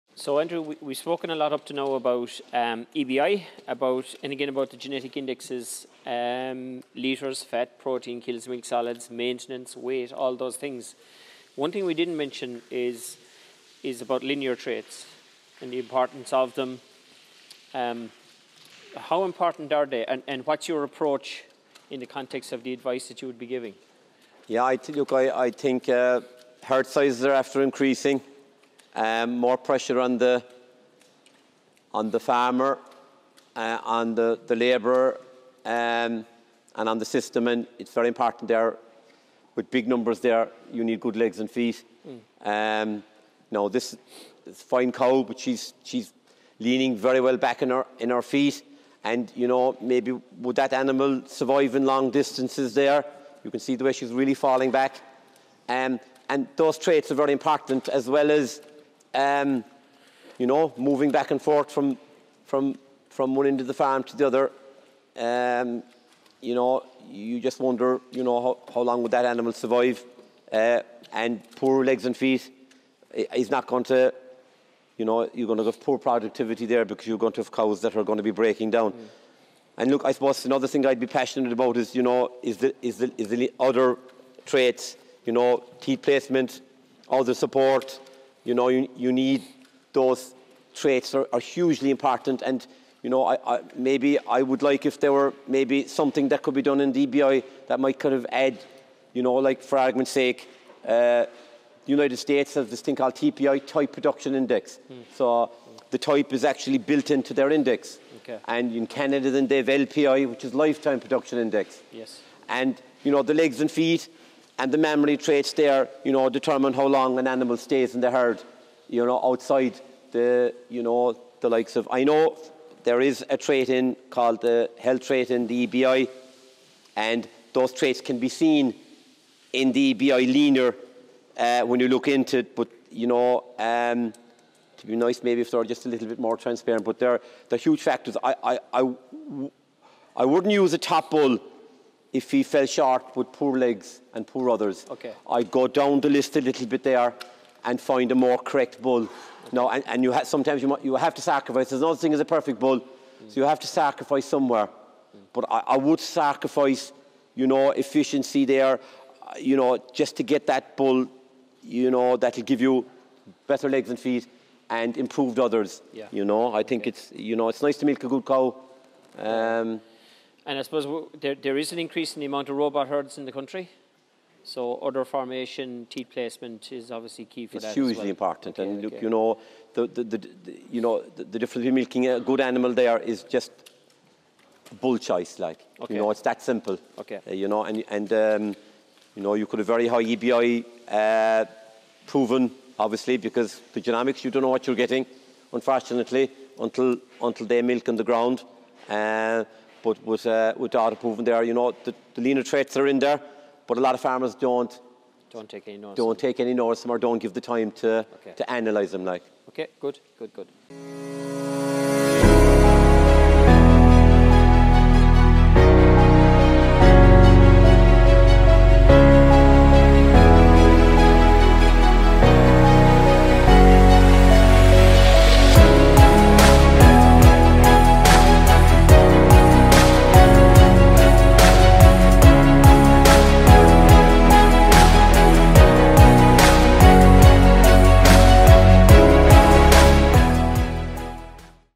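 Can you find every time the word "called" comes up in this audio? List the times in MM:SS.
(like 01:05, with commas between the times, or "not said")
01:42, 02:04.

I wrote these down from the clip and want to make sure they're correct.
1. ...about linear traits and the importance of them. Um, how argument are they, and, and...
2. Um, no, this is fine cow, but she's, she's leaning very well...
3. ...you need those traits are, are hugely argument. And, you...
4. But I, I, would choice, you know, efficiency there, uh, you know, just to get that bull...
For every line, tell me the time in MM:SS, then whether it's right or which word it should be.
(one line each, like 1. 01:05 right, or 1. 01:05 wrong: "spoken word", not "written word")
1. 00:14 wrong: "important", not "argument"
2. 00:42 right
3. 01:28 wrong: "important", not "argument"
4. 02:35 wrong: "sacrifice", not "choice".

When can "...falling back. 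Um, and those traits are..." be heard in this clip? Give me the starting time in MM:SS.
00:54.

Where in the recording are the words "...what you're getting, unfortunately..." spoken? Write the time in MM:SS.
03:14.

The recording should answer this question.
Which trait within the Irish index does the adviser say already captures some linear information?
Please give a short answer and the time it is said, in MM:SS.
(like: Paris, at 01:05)
health trait, at 02:04.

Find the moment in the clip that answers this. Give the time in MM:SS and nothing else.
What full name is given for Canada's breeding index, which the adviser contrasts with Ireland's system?
01:50.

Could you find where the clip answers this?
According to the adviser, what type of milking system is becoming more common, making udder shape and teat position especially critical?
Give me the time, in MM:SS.
02:52.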